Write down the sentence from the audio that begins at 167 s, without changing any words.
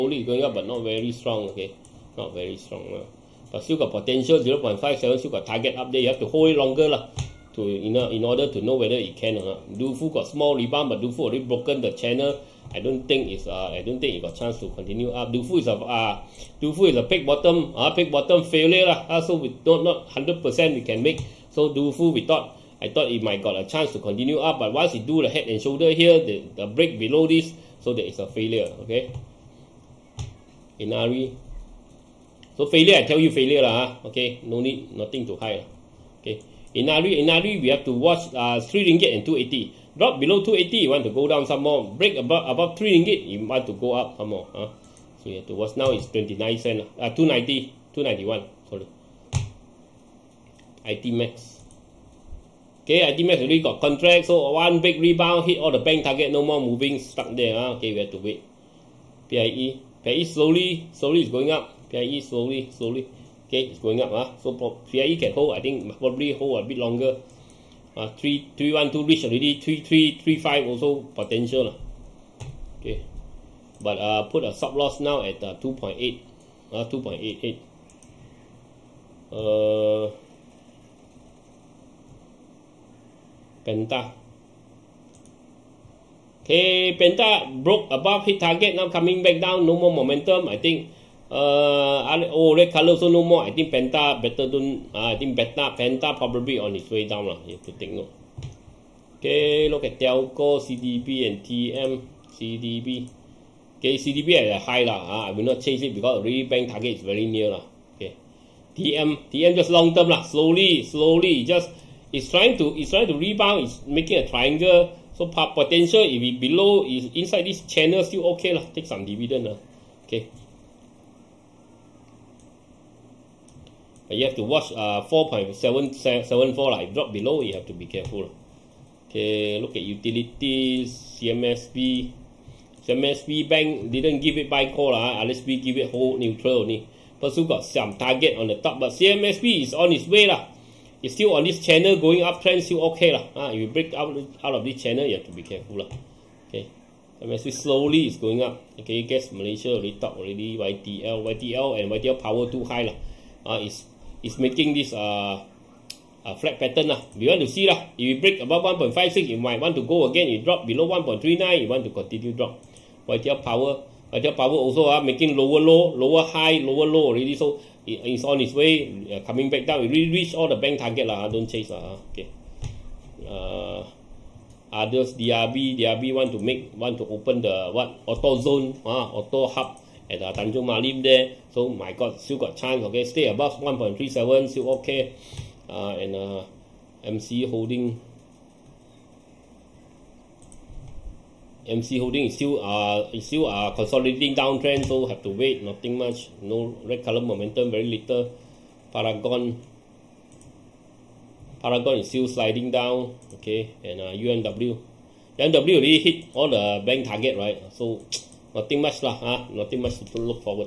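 So it, it's on its way, uh, coming back down.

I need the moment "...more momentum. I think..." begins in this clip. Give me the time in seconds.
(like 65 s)
89 s.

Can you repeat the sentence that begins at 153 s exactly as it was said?
Uh, it's is making this uh, uh, flat pattern lah.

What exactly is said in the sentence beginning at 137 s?
Pursu got some target on the top, but CMSB is on its way.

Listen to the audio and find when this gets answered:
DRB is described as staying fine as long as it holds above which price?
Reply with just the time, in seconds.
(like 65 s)
183 s.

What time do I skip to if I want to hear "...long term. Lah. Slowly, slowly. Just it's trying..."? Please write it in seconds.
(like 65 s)
109 s.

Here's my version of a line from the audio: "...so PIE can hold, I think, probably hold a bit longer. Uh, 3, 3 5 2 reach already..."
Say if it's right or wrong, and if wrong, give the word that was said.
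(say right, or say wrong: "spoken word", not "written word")
wrong: "1", not "5".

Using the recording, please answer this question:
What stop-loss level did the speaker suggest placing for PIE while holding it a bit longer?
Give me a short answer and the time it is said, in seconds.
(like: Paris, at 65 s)
2.88, at 76 s.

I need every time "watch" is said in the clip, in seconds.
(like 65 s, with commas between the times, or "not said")
37 s, 45 s, 124 s.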